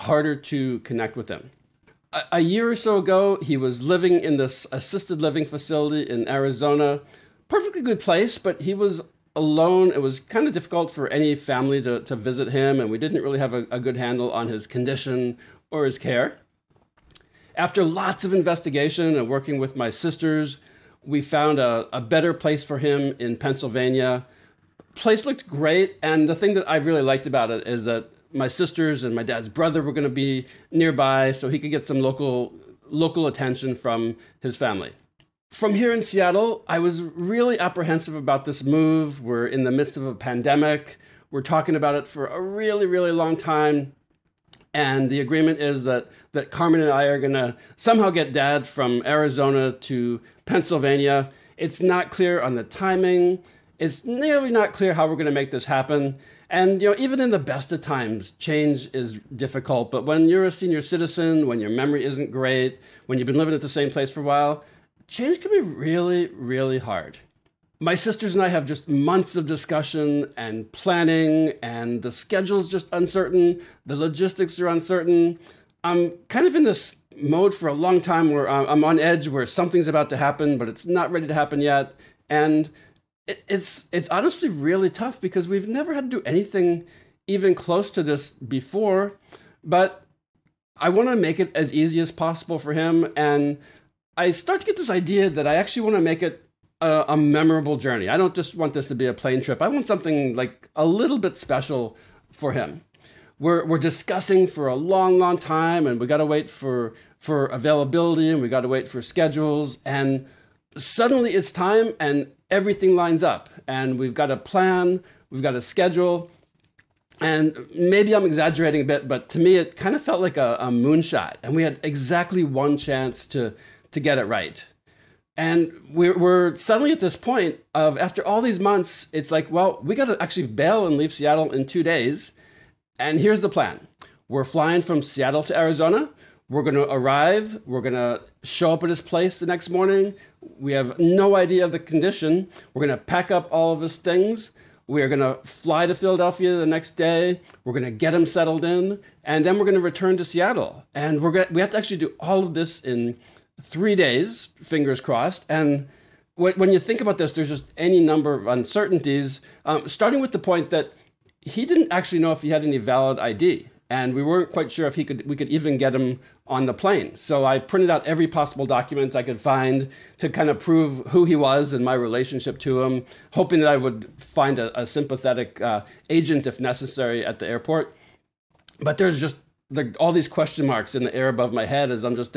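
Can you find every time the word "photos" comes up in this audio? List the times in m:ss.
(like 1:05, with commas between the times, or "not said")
not said.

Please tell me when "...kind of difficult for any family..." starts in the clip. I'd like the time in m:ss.
0:10.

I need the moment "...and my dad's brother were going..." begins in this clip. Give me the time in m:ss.
0:29.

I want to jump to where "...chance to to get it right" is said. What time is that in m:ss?
2:02.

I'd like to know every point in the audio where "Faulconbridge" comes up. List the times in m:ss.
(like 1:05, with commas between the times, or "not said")
not said.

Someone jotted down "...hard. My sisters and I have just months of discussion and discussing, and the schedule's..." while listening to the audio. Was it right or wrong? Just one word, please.
wrong.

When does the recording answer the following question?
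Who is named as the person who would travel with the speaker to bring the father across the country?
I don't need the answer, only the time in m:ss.
0:46.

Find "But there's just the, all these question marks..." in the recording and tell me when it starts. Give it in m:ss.
2:58.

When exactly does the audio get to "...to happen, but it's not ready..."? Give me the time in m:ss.
1:20.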